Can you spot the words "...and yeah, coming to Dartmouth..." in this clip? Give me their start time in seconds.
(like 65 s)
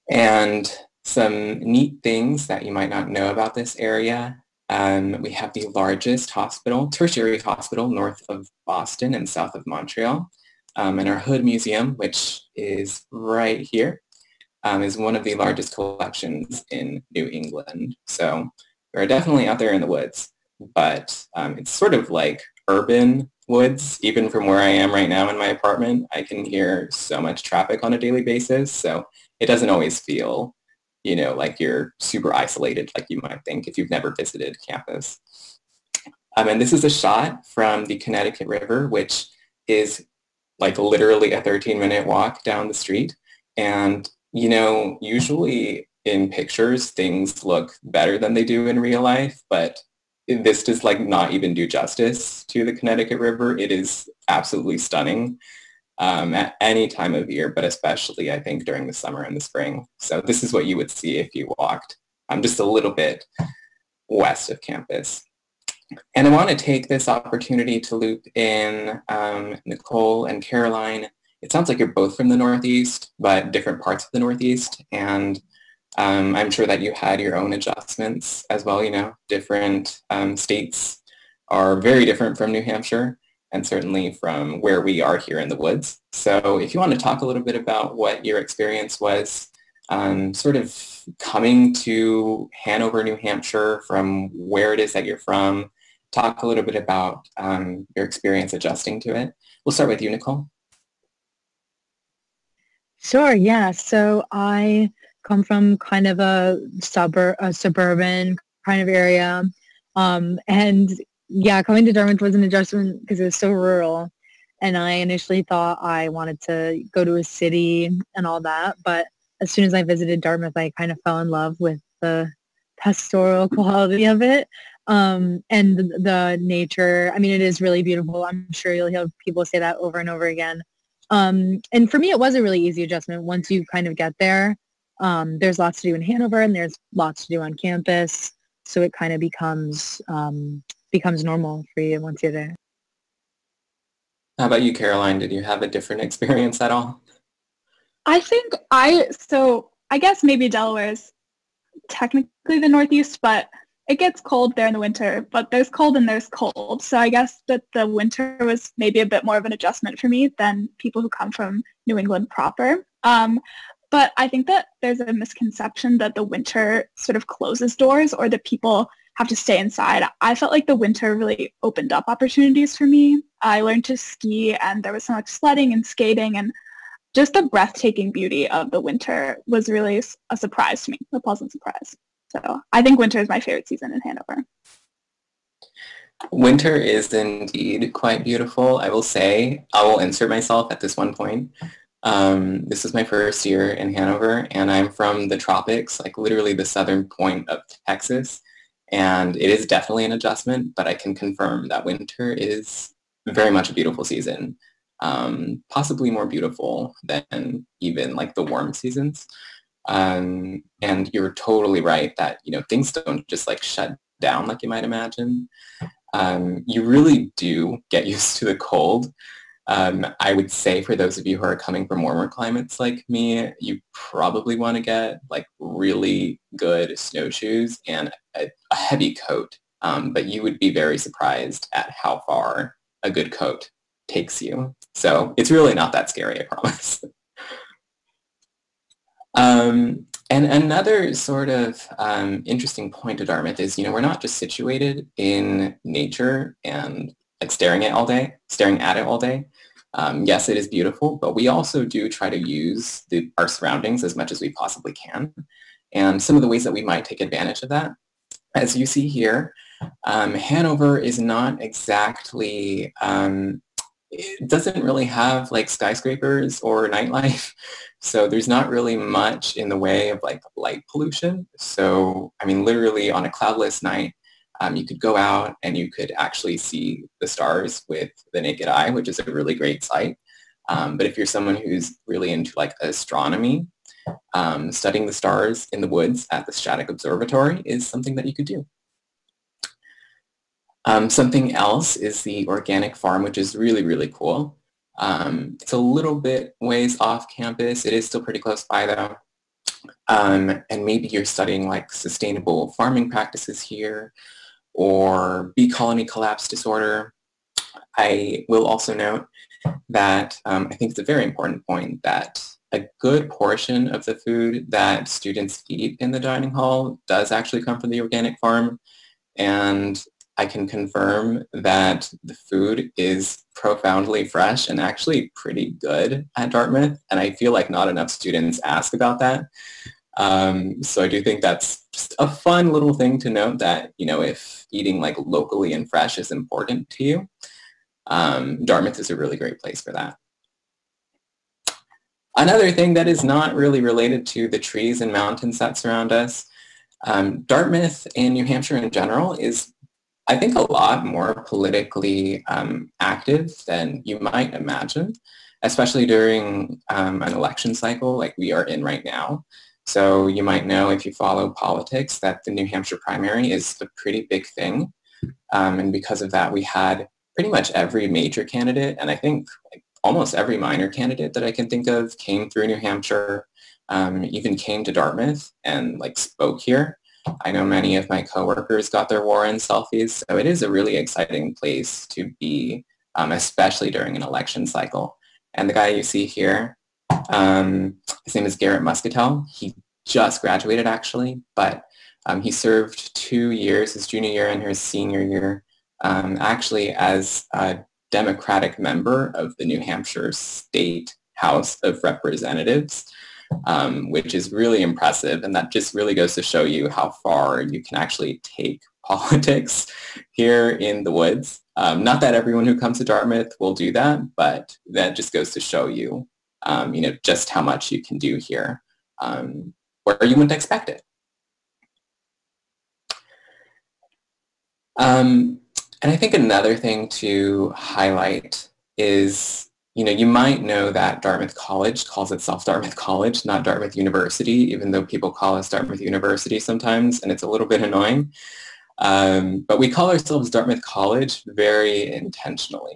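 110 s.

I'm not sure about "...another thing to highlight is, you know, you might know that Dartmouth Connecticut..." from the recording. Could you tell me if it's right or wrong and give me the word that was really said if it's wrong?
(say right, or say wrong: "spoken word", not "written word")
wrong: "College", not "Connecticut".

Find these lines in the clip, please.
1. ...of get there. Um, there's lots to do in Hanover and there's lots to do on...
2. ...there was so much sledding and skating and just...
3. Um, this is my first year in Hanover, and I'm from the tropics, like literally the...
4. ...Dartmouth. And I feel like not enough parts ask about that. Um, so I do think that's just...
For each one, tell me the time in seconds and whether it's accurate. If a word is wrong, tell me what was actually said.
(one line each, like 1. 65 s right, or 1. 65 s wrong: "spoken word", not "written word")
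1. 133 s right
2. 174 s right
3. 192 s right
4. 326 s wrong: "students", not "parts".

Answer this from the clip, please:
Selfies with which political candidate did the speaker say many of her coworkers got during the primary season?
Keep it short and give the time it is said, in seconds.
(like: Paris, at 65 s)
Warren, at 379 s.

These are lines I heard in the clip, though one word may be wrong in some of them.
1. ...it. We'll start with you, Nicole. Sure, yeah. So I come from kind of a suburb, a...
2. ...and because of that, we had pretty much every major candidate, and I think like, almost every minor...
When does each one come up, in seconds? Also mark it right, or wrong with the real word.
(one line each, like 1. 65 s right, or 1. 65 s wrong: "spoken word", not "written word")
1. 99 s right
2. 365 s right.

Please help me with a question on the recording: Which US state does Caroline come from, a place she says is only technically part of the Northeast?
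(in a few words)
Delaware.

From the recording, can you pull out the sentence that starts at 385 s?
And the guy you see here, um, his name is Garrett Muscatel.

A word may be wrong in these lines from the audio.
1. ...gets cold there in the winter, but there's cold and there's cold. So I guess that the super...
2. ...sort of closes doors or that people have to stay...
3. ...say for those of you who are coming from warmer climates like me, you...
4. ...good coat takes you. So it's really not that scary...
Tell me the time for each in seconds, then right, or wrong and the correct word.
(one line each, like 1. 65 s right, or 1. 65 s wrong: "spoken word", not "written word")
1. 153 s wrong: "winter", not "super"
2. 166 s right
3. 220 s right
4. 233 s right.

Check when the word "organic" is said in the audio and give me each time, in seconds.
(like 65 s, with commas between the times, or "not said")
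292 s, 318 s.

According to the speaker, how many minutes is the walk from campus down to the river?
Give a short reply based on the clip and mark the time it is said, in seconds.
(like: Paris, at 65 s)
13, at 41 s.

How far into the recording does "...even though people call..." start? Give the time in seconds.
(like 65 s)
434 s.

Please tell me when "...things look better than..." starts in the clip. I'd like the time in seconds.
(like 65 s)
46 s.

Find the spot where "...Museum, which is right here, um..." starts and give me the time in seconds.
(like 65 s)
11 s.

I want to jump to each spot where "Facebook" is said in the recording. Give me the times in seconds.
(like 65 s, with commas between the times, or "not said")
not said.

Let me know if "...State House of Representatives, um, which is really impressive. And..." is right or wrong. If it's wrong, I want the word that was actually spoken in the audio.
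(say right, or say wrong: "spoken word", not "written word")
right.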